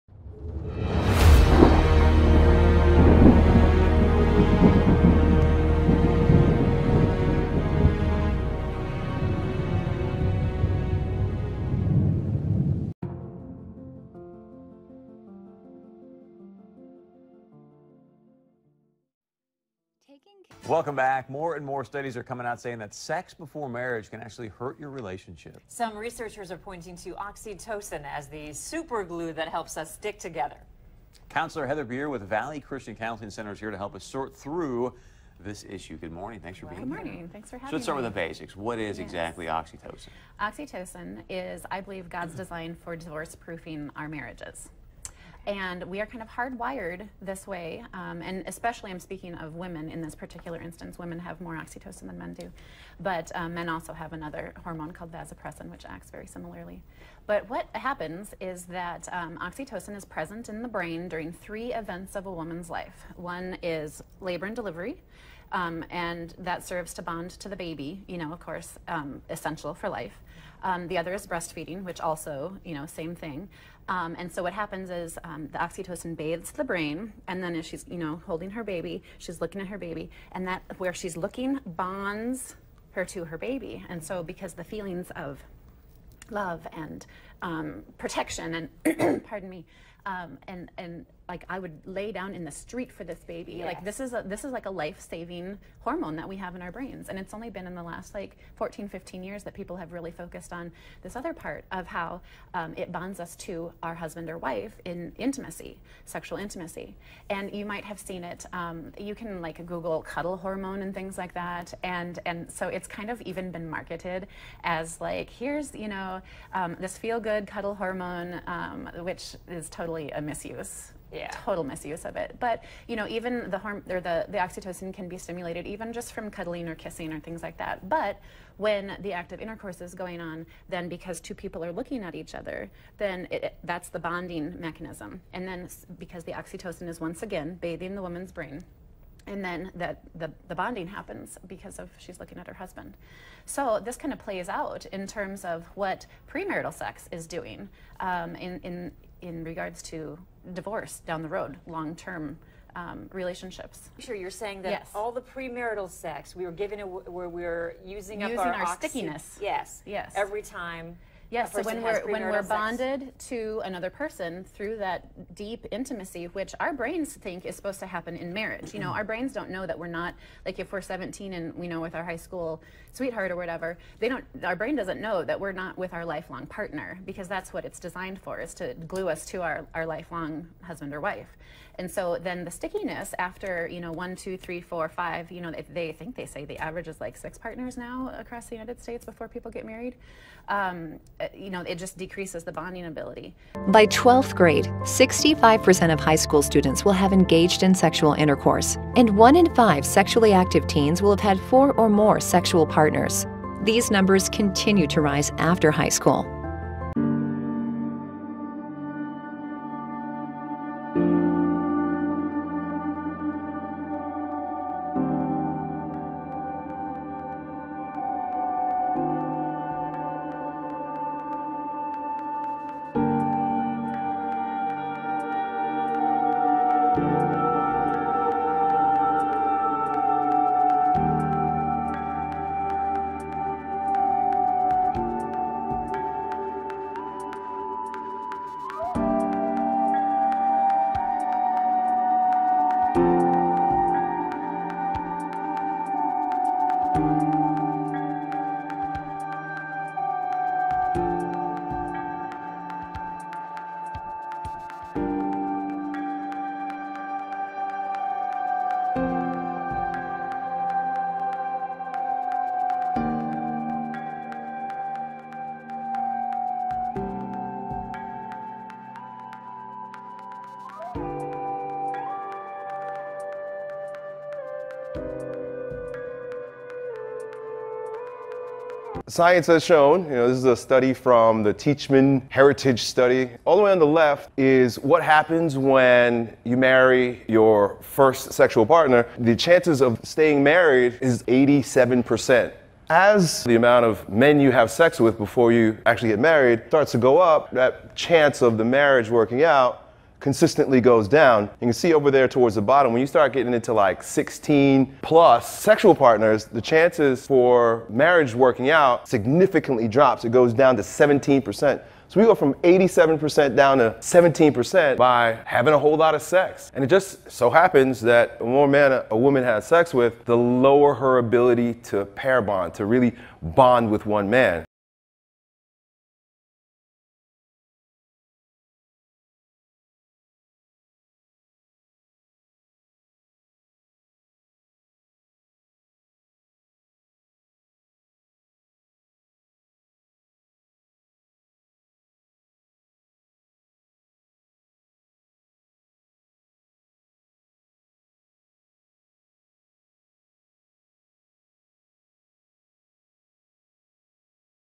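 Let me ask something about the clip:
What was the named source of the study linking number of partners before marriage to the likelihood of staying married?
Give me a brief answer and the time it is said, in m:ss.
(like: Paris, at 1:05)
Teachman Heritage Study, at 4:41.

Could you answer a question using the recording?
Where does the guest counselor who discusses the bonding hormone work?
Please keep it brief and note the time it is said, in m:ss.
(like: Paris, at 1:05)
Valley Christian Counseling Center, at 0:32.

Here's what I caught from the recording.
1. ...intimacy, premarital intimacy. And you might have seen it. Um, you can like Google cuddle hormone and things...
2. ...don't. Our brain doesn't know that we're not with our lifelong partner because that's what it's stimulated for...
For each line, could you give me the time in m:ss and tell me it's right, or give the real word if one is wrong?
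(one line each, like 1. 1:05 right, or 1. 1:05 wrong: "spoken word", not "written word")
1. 1:45 wrong: "sexual", not "premarital"
2. 2:54 wrong: "designed", not "stimulated".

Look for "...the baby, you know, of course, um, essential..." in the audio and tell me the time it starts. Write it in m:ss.
1:07.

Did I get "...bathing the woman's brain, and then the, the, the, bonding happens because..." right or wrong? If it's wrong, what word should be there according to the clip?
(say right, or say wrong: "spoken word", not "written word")
right.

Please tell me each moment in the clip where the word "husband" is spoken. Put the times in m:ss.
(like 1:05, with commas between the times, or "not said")
1:43, 2:22, 3:00.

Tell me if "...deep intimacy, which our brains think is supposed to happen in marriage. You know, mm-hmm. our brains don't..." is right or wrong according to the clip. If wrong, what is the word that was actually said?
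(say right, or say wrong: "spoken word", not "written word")
right.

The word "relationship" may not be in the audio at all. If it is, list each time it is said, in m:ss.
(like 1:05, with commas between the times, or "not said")
0:24, 2:33.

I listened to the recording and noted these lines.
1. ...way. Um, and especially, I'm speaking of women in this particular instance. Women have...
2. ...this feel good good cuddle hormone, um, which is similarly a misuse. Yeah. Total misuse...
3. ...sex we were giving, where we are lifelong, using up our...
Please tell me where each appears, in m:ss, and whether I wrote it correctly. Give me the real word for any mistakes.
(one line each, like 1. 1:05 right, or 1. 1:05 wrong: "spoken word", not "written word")
1. 0:47 right
2. 1:56 wrong: "totally", not "similarly"
3. 2:35 wrong: "using", not "lifelong".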